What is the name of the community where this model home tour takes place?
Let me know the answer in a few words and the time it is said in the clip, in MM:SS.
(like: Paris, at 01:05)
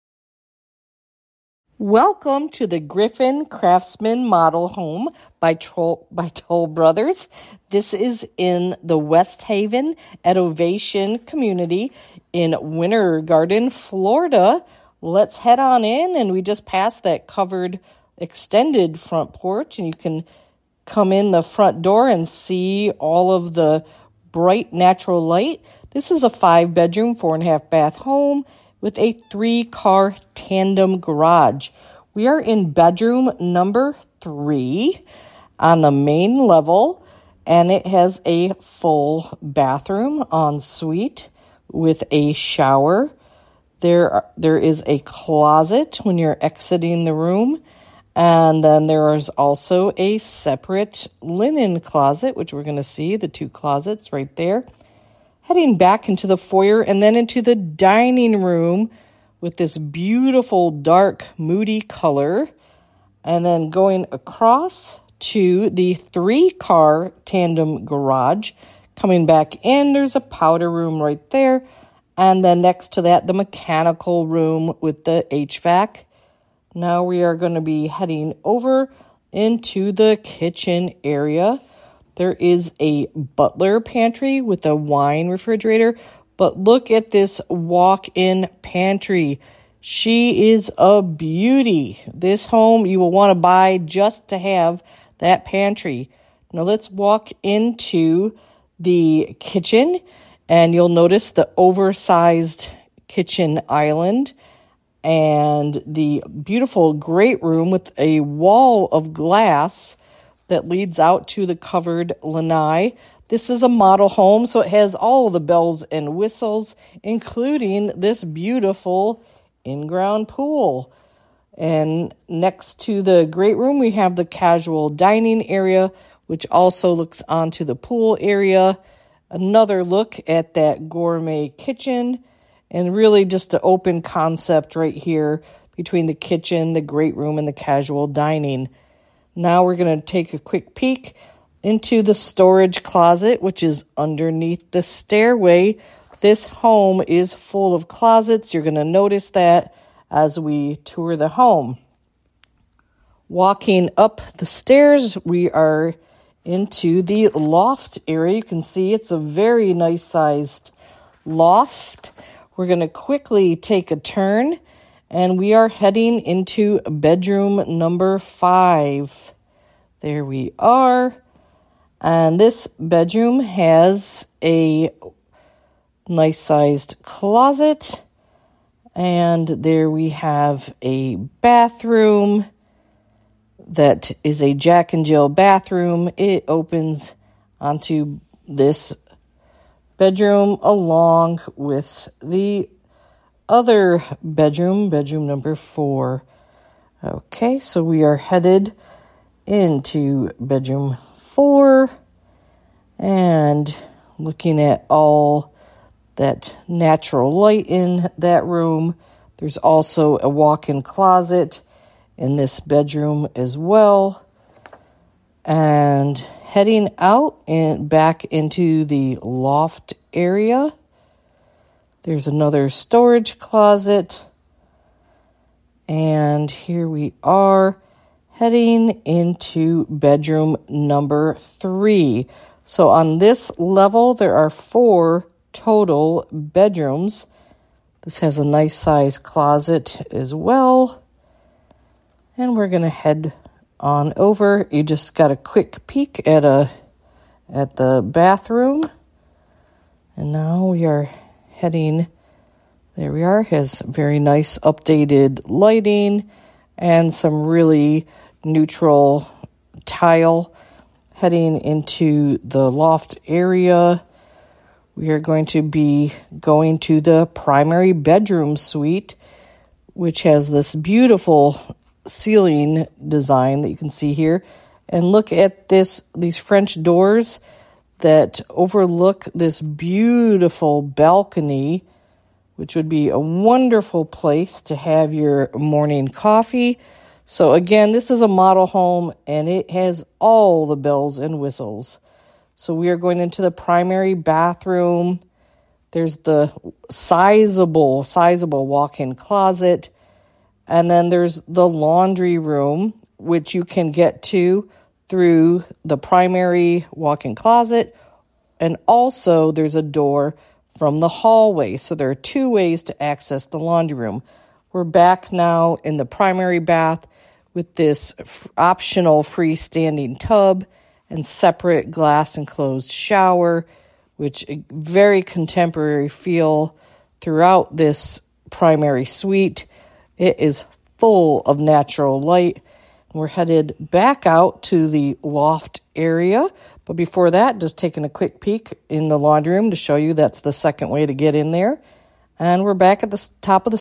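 Westhaven at Ovation, at 00:08.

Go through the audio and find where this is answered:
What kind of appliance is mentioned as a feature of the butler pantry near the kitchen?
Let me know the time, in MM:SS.
01:24.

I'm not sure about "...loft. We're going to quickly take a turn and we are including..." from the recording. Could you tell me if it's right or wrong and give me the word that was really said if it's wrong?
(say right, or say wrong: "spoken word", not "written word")
wrong: "heading", not "including".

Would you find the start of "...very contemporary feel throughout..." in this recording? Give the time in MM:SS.
05:24.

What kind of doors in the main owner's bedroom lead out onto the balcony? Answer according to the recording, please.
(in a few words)
French doors.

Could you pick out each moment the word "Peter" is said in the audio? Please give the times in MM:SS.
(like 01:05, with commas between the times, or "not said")
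not said.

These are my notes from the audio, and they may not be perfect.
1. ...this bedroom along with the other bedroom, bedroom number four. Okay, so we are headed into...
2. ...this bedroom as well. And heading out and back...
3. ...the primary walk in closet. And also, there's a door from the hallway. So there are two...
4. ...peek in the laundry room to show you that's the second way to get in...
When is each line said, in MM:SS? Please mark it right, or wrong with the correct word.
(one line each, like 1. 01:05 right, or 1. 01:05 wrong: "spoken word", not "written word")
1. 03:08 right
2. 03:32 right
3. 05:05 right
4. 05:38 right.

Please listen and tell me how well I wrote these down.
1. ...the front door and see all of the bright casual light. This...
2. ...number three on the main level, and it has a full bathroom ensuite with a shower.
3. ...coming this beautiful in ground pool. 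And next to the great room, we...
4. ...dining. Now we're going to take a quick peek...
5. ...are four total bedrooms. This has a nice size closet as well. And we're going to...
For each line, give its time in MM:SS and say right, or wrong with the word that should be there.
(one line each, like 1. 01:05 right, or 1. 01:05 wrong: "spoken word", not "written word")
1. 00:21 wrong: "natural", not "casual"
2. 00:33 right
3. 01:57 wrong: "including", not "coming"
4. 02:18 right
5. 03:54 right.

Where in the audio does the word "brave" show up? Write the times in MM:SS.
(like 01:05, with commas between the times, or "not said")
not said.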